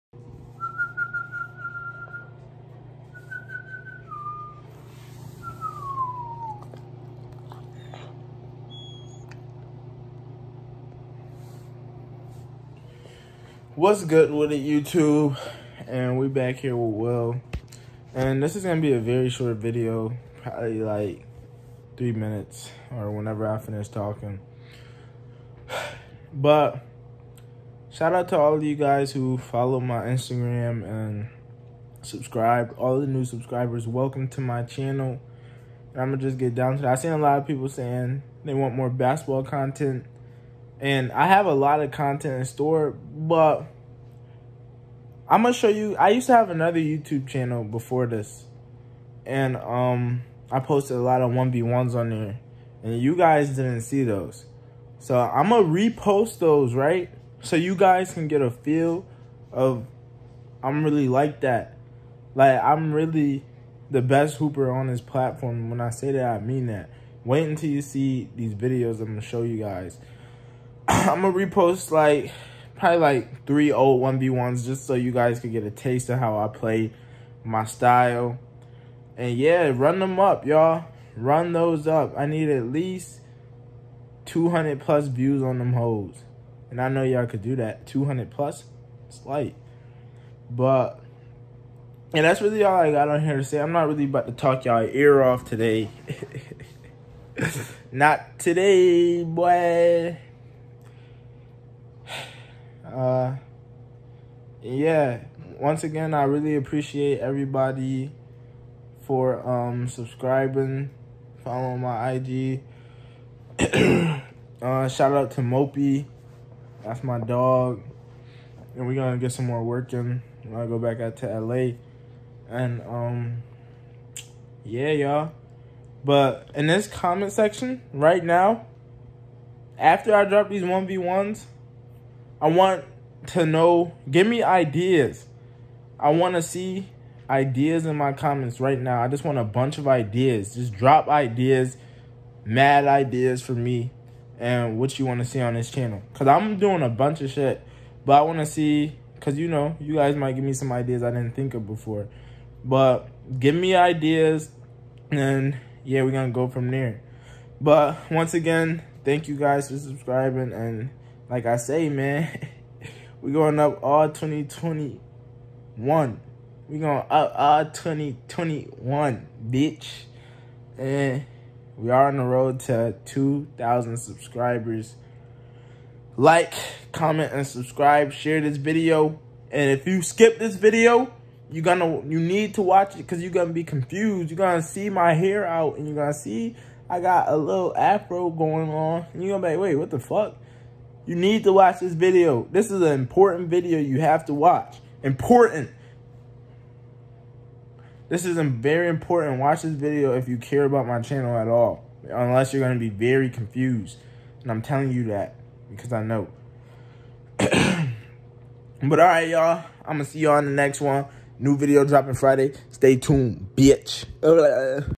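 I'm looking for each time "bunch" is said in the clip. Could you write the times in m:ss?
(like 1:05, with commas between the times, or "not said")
2:19, 2:26.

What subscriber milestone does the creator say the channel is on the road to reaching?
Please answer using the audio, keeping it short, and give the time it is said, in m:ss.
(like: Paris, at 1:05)
2,000, at 2:53.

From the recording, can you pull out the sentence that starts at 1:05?
When I say that, I mean that.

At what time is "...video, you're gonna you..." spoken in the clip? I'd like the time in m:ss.
3:00.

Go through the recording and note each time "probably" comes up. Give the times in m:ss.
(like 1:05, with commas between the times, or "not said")
0:20, 1:12.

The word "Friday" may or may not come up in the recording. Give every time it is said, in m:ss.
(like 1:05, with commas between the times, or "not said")
3:32.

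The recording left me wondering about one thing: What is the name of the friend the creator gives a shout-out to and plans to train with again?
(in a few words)
Mopey.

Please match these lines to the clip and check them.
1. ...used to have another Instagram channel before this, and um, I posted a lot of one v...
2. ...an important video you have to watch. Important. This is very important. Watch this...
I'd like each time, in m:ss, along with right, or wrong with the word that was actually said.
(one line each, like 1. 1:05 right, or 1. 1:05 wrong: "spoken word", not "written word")
1. 0:46 wrong: "YouTube", not "Instagram"
2. 3:12 right.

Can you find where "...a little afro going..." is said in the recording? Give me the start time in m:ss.
3:07.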